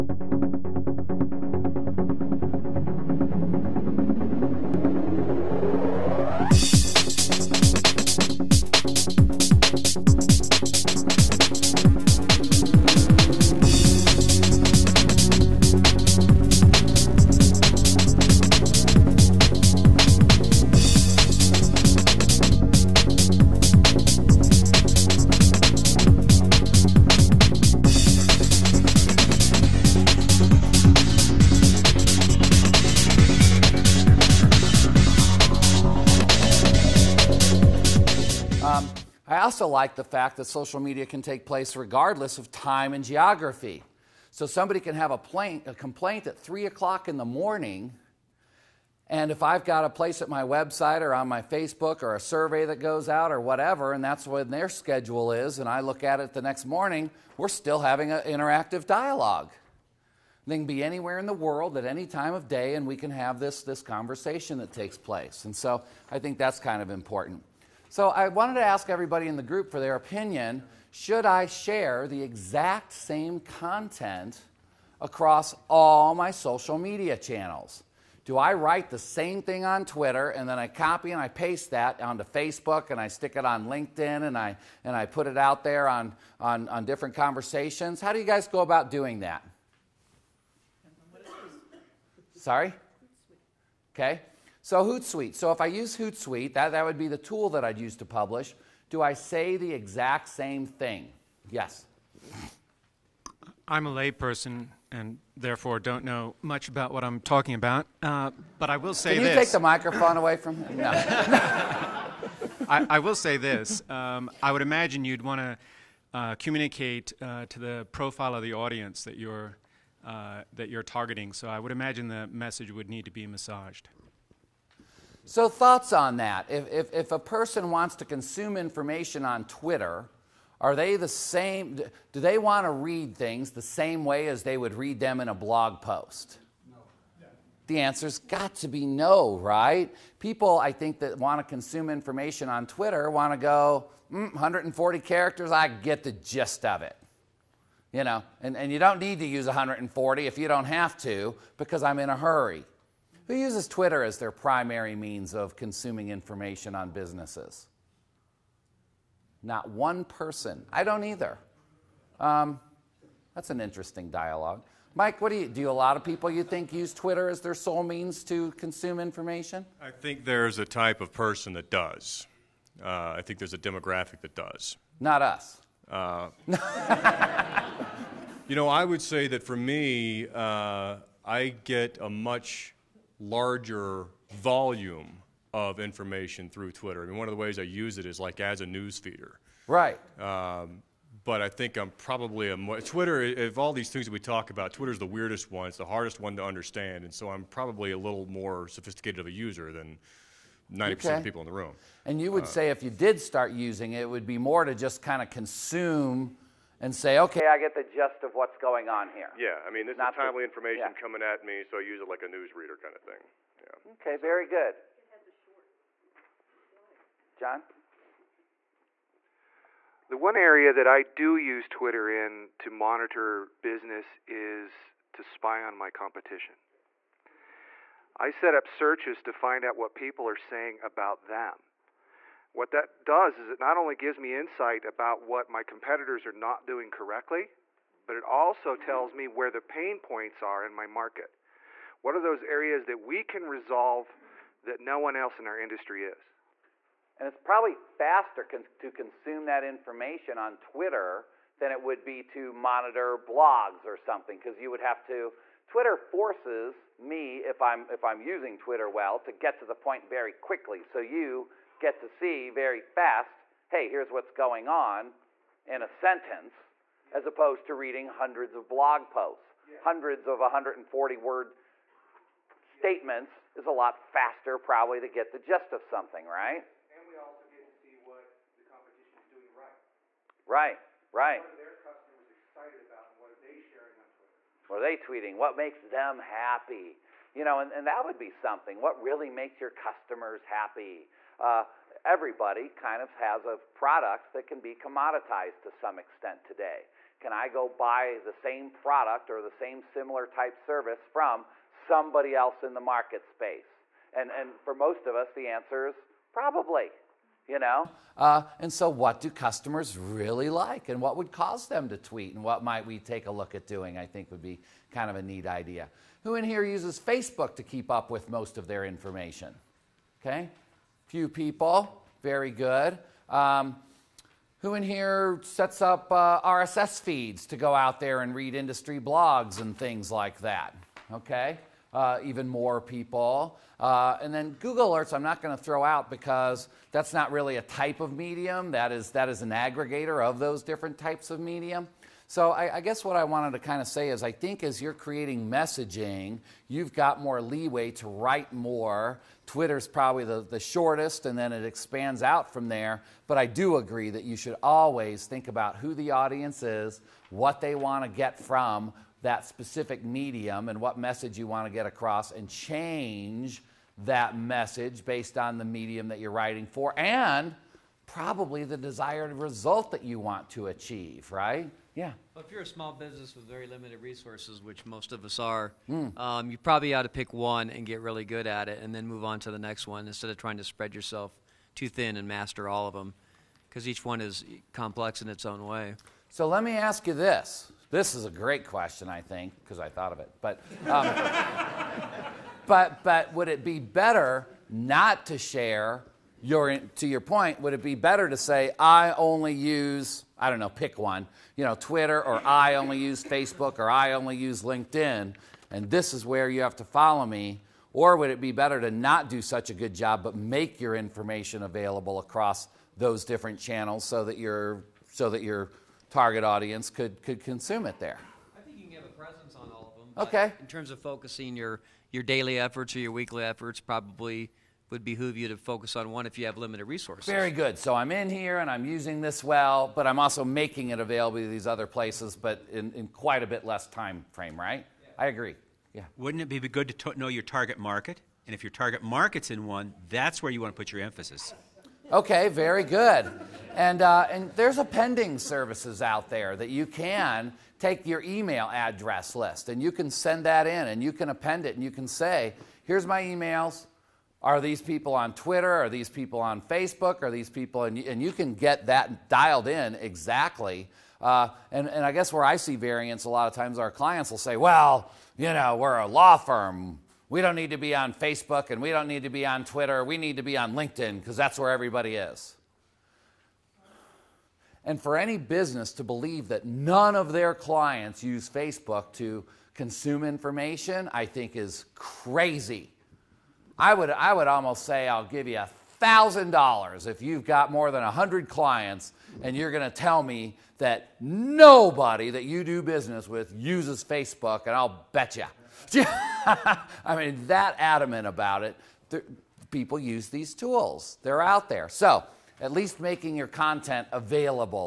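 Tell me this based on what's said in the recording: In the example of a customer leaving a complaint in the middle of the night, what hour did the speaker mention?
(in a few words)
3 o'clock in the morning.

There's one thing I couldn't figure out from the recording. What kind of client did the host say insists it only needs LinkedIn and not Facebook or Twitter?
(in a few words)
a law firm.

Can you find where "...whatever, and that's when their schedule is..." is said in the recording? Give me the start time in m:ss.
0:53.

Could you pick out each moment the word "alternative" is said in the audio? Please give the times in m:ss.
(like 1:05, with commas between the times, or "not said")
not said.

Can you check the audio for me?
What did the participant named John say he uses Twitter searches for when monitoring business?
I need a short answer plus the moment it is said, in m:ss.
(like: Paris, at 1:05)
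spy on my competition, at 3:45.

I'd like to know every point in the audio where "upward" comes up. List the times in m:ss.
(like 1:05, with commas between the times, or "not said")
not said.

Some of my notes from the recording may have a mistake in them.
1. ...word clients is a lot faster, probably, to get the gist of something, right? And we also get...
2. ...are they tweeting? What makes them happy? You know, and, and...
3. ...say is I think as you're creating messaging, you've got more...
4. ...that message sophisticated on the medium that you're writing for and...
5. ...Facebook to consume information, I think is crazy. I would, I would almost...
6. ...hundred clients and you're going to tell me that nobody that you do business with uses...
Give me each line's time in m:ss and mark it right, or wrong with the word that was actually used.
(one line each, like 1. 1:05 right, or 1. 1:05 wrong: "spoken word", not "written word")
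1. 4:31 wrong: "statements", not "clients"
2. 4:44 right
3. 5:43 right
4. 6:04 wrong: "based", not "sophisticated"
5. 7:58 right
6. 8:08 right.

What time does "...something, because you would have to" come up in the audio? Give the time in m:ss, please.
4:13.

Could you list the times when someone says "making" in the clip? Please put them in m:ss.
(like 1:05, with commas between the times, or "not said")
7:10, 8:23.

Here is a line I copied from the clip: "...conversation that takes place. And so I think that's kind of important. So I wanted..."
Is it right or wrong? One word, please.
right.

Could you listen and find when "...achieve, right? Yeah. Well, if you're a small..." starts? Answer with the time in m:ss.
6:10.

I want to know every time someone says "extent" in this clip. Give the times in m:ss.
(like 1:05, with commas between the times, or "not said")
4:55.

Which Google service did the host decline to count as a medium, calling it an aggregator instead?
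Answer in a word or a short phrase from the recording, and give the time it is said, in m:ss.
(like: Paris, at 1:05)
Google Alerts, at 5:34.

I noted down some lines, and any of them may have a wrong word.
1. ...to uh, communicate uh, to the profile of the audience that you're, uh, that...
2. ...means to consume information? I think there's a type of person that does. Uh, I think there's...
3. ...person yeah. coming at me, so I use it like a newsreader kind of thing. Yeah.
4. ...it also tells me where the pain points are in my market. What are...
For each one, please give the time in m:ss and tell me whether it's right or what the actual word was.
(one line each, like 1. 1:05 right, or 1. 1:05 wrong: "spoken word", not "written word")
1. 1:55 right
2. 2:47 right
3. 3:30 wrong: "information", not "person"
4. 3:58 right.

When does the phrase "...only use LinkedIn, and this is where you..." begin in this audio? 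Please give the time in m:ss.
6:44.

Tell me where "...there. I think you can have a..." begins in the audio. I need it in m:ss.
6:57.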